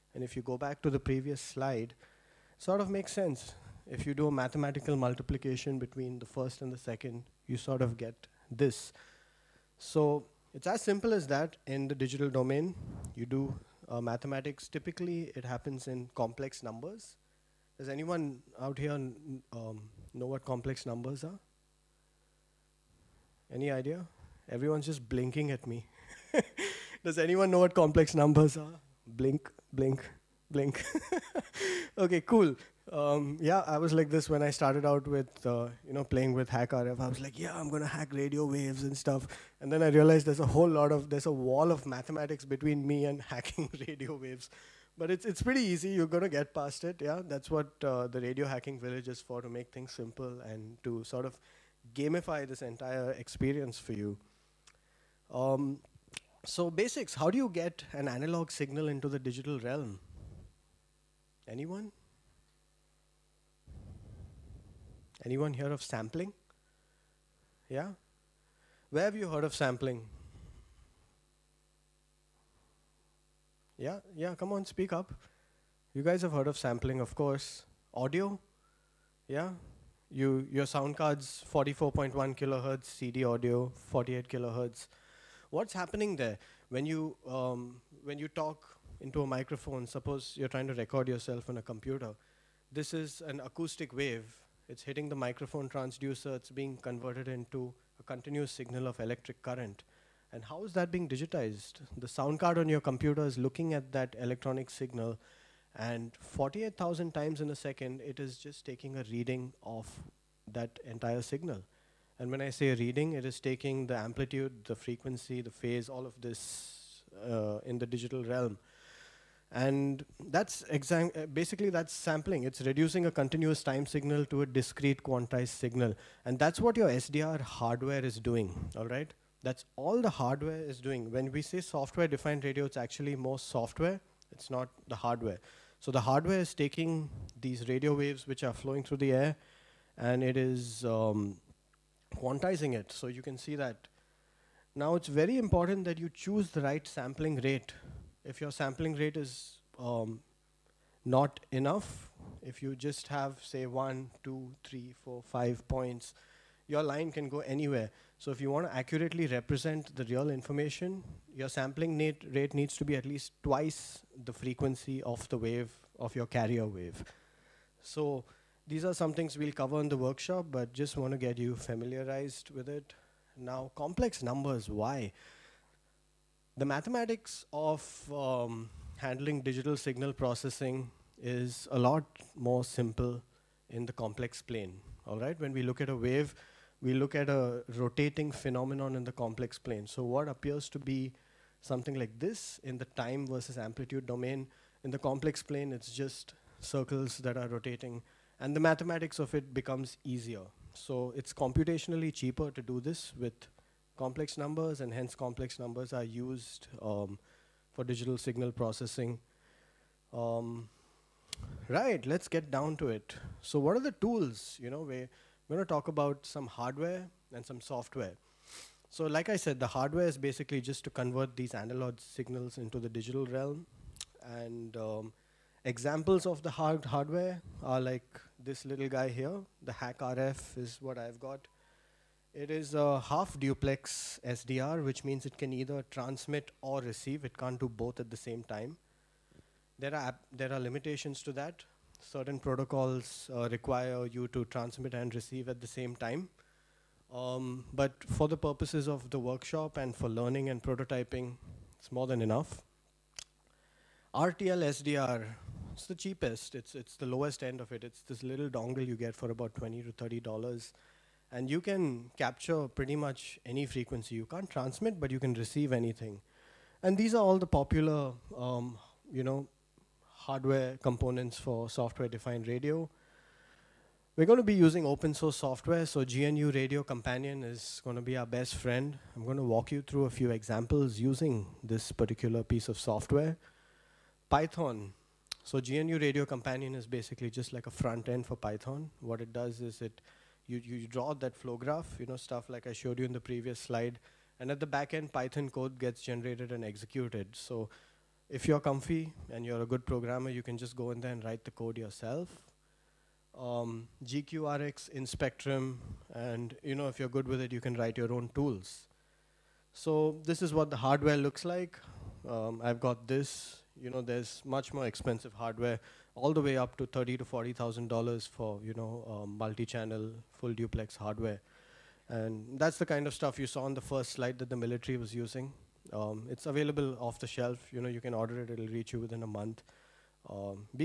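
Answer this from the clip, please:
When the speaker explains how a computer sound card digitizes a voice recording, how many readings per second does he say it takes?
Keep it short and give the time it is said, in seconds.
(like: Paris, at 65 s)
48,000, at 106 s.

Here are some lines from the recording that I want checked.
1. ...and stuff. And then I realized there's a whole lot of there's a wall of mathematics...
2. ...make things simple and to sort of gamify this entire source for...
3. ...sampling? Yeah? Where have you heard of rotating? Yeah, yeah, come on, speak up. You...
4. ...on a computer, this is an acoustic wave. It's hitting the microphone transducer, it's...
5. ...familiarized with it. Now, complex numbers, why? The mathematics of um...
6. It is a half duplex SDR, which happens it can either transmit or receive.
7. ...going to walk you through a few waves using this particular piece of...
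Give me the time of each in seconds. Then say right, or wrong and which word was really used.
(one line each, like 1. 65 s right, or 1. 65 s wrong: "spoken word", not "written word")
1. 38 s right
2. 49 s wrong: "experience", not "source"
3. 65 s wrong: "sampling", not "rotating"
4. 91 s right
5. 171 s right
6. 232 s wrong: "means", not "happens"
7. 279 s wrong: "examples", not "waves".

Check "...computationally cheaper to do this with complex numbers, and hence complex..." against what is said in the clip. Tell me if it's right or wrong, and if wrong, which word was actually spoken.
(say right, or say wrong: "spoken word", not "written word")
right.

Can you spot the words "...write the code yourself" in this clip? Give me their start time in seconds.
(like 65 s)
301 s.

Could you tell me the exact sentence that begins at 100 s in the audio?
And how is that being digitized?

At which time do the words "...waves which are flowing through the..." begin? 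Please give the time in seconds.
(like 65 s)
137 s.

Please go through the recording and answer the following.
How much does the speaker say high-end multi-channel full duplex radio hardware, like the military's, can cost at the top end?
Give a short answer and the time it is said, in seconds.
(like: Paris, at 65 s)
$30,000 to $40,000, at 316 s.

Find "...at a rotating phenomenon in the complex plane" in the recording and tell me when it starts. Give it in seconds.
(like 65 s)
187 s.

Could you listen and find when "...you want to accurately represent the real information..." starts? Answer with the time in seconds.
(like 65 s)
158 s.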